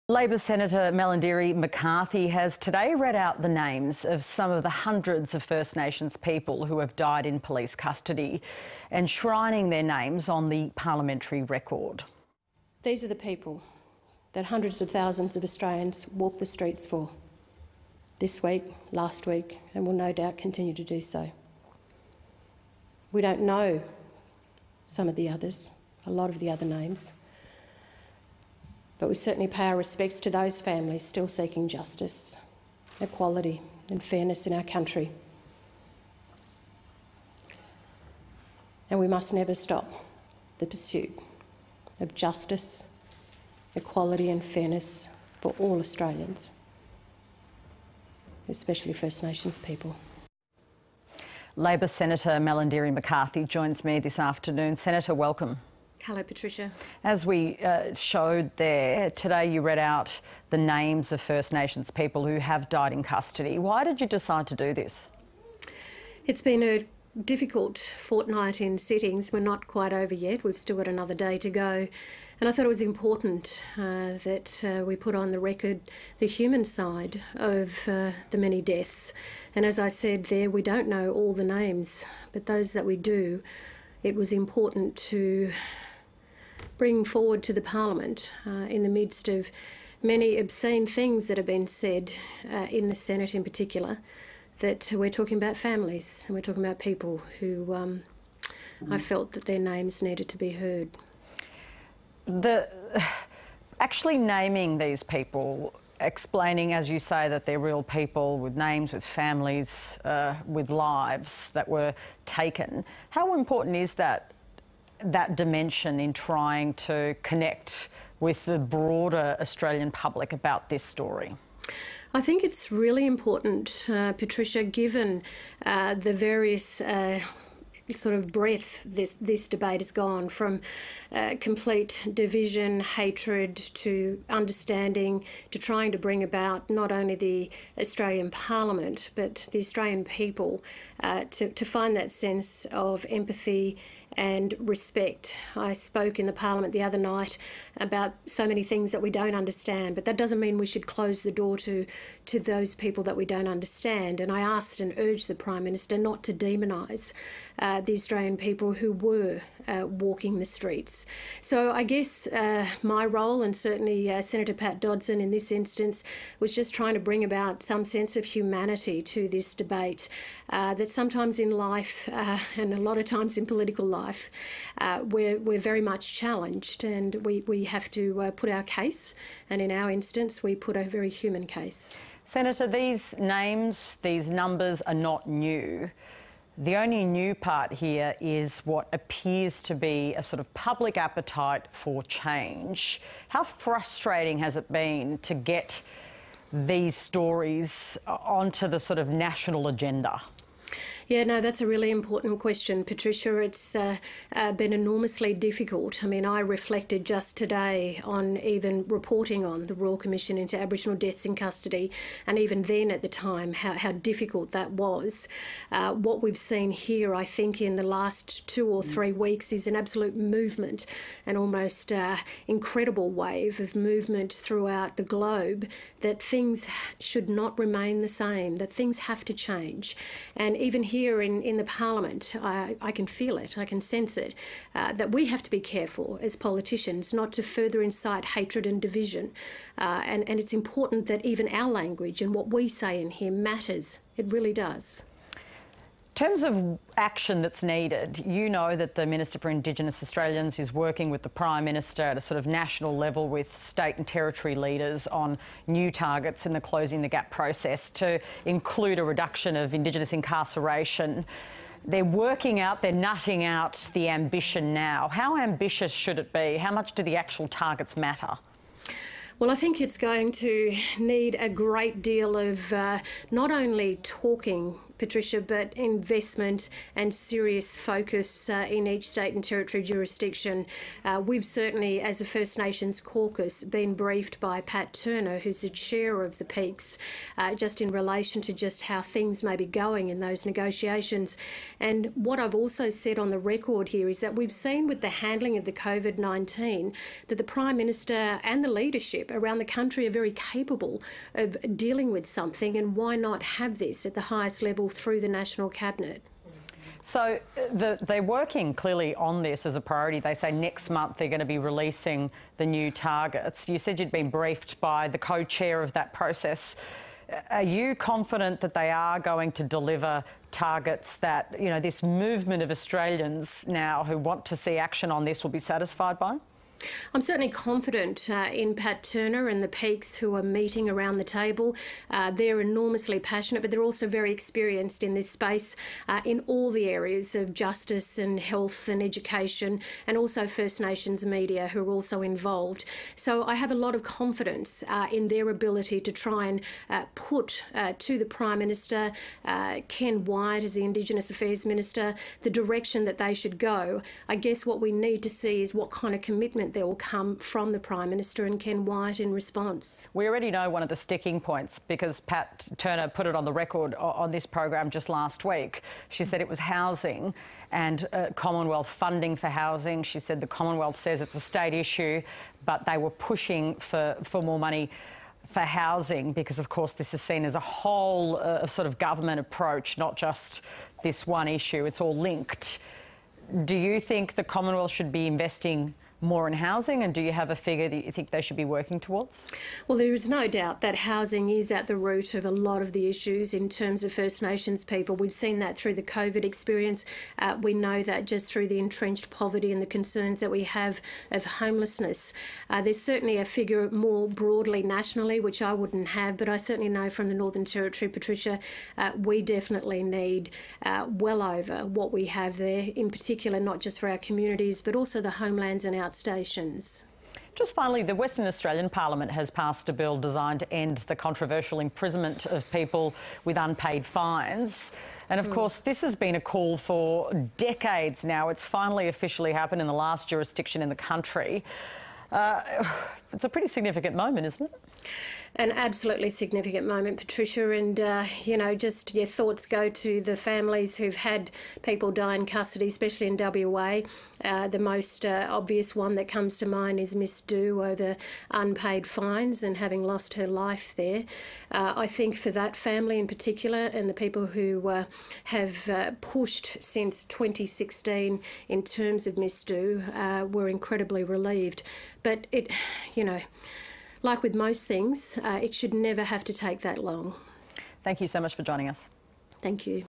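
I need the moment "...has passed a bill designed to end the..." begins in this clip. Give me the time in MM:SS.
06:59.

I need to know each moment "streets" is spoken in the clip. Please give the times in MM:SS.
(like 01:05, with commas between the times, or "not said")
00:16, 02:40.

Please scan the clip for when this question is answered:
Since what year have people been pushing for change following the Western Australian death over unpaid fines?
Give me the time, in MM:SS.
07:37.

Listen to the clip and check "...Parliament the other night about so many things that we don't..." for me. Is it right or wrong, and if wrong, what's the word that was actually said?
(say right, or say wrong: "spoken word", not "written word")
right.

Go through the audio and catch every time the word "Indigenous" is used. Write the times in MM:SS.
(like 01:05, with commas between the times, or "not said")
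04:09, 04:19, 05:50.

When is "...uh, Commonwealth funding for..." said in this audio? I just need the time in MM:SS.
06:08.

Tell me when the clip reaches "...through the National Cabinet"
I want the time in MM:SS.
05:04.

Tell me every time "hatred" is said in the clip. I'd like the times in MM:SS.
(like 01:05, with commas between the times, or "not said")
02:12, 03:58.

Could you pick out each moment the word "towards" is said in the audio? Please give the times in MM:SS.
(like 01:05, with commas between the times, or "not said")
06:28.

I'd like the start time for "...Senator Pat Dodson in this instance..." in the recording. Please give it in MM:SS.
02:44.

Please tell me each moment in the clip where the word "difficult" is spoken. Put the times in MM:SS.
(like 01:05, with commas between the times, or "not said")
01:07, 03:25, 03:33.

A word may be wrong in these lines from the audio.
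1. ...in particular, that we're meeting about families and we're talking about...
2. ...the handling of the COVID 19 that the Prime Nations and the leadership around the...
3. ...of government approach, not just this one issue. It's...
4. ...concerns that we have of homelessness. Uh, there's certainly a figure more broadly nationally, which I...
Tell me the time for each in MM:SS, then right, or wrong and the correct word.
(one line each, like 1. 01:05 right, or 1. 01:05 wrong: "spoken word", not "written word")
1. 01:33 wrong: "talking", not "meeting"
2. 04:55 wrong: "Minister", not "Nations"
3. 06:18 right
4. 06:39 right.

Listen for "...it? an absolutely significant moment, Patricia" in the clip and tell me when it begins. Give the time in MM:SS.
07:14.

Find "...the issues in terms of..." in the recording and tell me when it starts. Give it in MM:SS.
06:32.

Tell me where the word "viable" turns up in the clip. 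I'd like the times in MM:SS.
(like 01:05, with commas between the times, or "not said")
not said.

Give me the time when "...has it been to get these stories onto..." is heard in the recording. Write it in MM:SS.
03:14.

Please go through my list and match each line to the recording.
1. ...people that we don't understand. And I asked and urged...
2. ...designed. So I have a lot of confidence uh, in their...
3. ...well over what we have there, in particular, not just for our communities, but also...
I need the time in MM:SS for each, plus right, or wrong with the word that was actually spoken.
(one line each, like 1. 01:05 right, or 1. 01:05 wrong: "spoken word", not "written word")
1. 02:32 right
2. 05:42 wrong: "involved", not "designed"
3. 06:51 right.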